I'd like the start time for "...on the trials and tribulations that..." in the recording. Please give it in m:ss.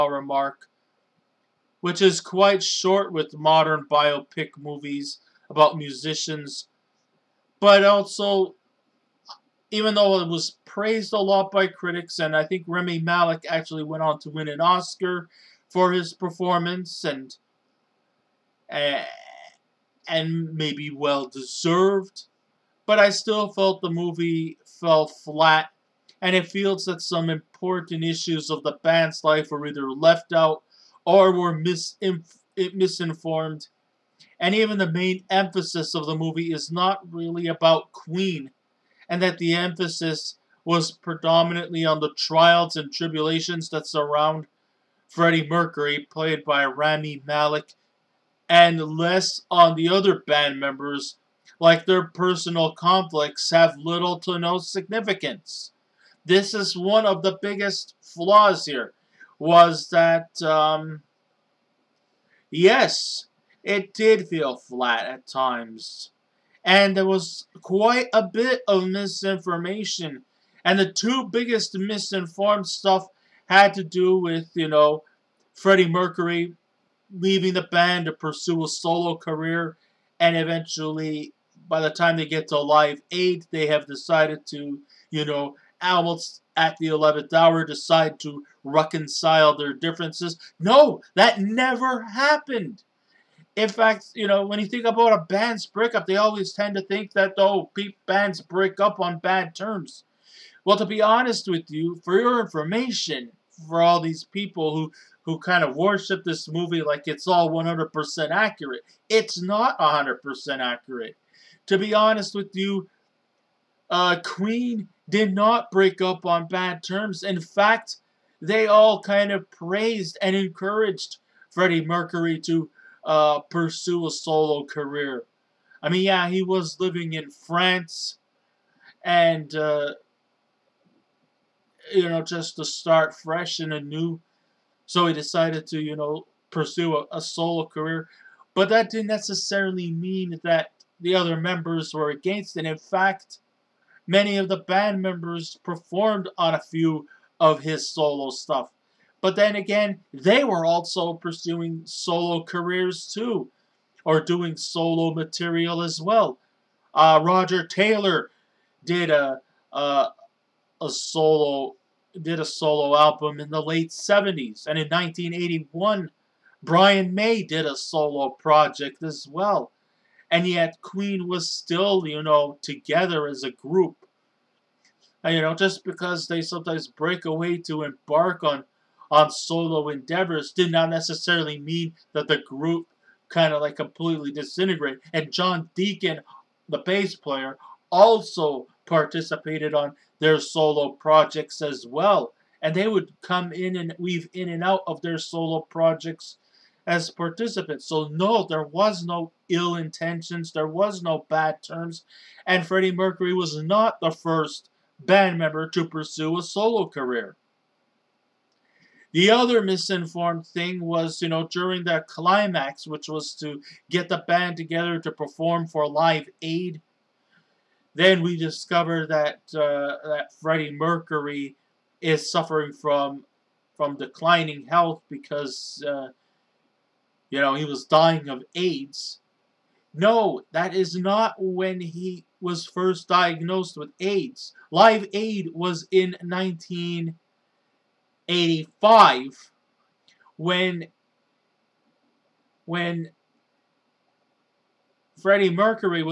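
0:41.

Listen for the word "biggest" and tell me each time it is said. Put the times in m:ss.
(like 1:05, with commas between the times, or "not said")
0:57, 1:11.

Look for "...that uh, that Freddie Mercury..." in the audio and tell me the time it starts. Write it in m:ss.
3:39.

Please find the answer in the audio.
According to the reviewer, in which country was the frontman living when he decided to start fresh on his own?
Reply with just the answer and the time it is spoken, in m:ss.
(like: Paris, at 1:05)
France, at 2:07.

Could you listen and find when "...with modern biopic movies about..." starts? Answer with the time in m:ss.
0:03.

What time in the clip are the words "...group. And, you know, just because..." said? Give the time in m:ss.
2:53.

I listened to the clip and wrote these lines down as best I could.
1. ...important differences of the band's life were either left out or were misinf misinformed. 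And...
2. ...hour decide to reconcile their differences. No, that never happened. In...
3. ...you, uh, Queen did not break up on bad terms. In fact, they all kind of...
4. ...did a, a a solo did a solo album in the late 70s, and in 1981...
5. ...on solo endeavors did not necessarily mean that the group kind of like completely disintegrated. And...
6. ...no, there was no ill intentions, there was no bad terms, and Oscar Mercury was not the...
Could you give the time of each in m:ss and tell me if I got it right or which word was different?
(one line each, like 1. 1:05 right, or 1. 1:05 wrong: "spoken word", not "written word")
1. 0:27 wrong: "issues", not "differences"
2. 1:27 right
3. 1:52 right
4. 2:38 right
5. 2:59 right
6. 3:18 wrong: "Freddie", not "Oscar".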